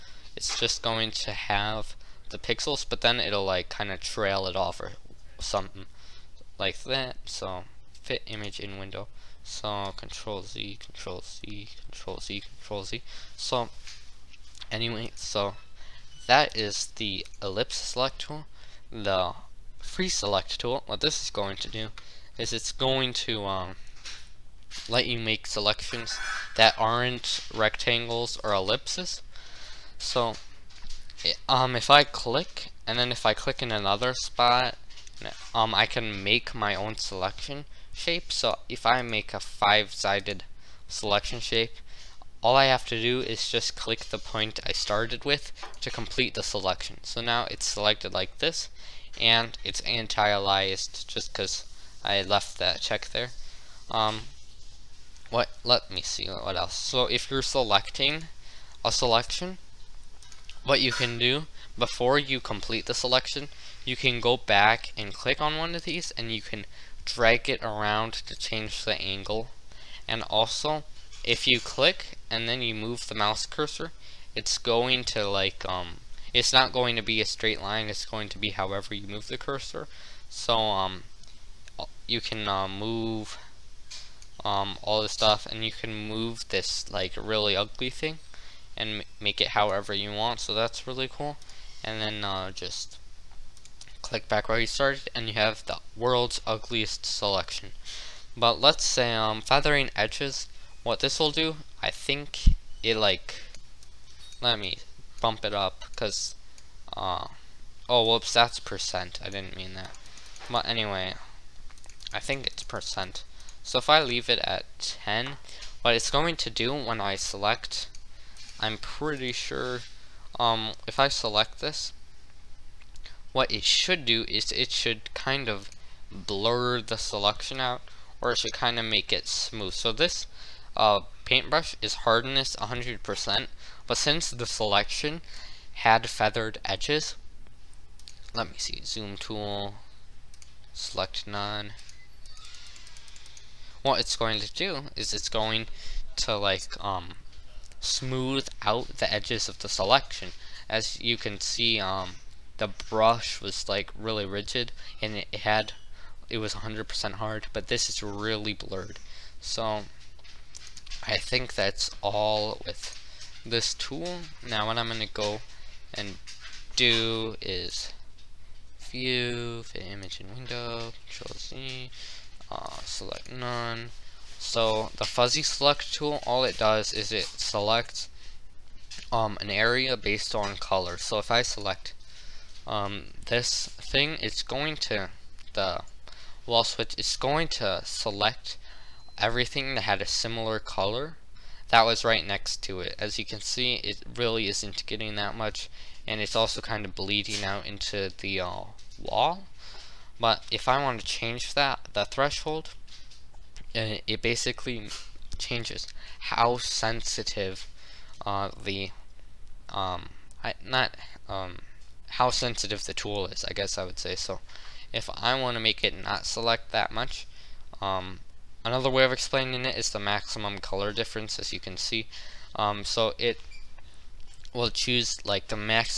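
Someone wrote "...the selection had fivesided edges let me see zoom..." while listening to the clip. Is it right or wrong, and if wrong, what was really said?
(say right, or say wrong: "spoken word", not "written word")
wrong: "feathered", not "fivesided".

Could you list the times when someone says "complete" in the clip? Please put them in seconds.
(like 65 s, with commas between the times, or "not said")
45 s, 62 s.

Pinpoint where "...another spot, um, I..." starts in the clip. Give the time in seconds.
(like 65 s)
33 s.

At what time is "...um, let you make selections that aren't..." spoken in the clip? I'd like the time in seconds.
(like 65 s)
23 s.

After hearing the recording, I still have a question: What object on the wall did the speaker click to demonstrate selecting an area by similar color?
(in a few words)
The wall switch.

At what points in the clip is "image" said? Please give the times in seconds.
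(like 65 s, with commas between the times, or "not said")
8 s, 169 s.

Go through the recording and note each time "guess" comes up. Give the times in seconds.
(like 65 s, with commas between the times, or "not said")
213 s.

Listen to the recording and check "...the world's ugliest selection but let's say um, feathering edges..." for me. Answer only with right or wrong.
right.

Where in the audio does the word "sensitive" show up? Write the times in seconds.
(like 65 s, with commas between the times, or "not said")
206 s, 212 s.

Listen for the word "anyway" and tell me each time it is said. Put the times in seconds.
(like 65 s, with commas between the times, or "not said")
14 s, 110 s.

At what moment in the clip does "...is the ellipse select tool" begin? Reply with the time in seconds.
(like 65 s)
16 s.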